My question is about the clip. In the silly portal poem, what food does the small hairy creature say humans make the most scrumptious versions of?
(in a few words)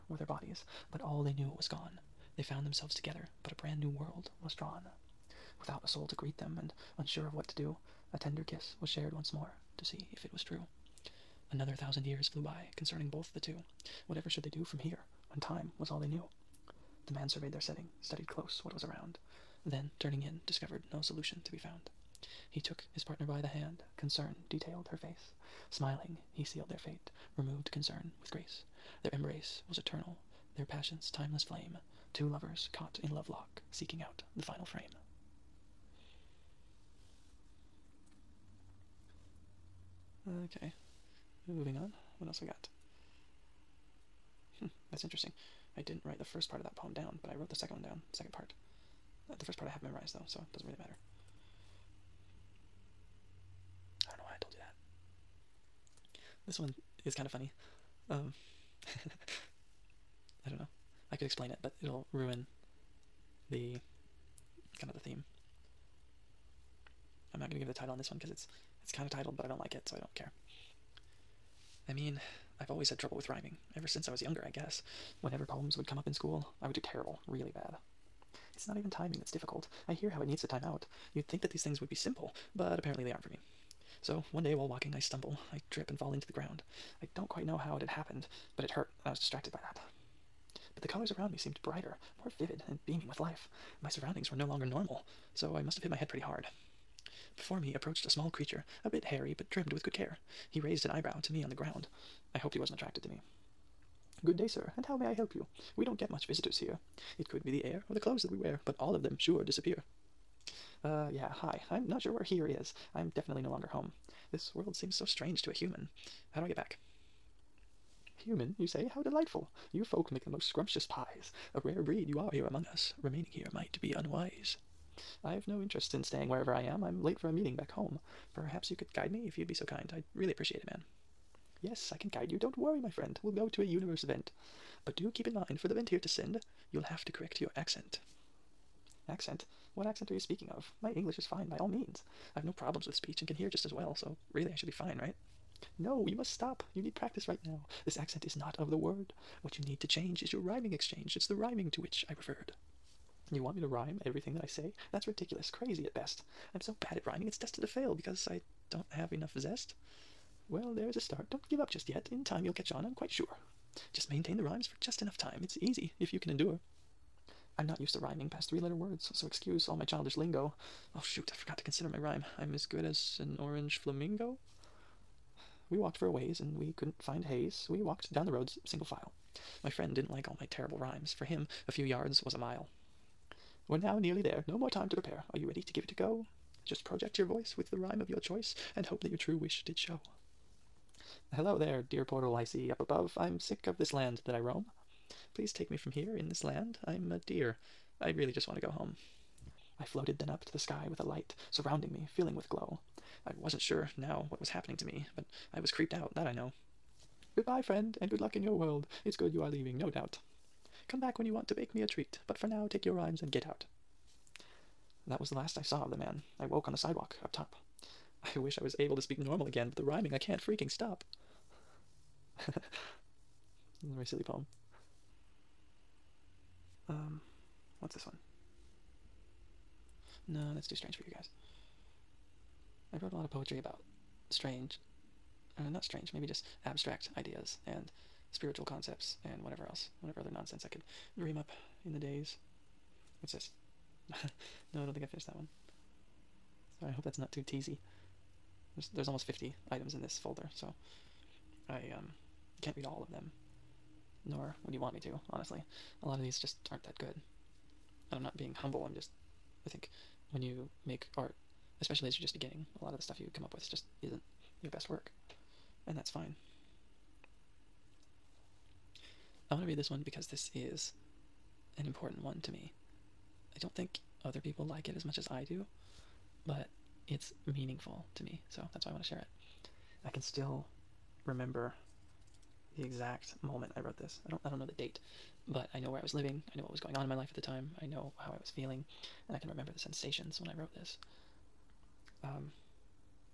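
pies.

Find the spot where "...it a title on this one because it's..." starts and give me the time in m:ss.
1:07.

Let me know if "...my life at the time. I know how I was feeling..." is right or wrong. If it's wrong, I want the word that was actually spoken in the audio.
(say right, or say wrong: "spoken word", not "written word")
right.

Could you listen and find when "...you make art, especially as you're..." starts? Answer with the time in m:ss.
4:20.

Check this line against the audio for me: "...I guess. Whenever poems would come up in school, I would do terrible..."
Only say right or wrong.
right.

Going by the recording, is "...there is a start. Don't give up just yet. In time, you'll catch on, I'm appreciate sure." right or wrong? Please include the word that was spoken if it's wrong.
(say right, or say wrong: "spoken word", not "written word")
wrong: "quite", not "appreciate".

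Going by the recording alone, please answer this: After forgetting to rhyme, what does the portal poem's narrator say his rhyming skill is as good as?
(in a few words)
an orange flamingo.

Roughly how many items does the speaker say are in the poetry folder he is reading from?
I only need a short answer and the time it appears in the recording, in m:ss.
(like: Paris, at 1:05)
almost 50, at 4:09.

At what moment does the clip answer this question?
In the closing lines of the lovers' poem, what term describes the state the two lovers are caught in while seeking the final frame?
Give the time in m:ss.
0:33.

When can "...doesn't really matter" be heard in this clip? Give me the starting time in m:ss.
0:50.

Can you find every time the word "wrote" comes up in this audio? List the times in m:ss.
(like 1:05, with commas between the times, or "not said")
0:47, 3:53, 4:43, 4:50.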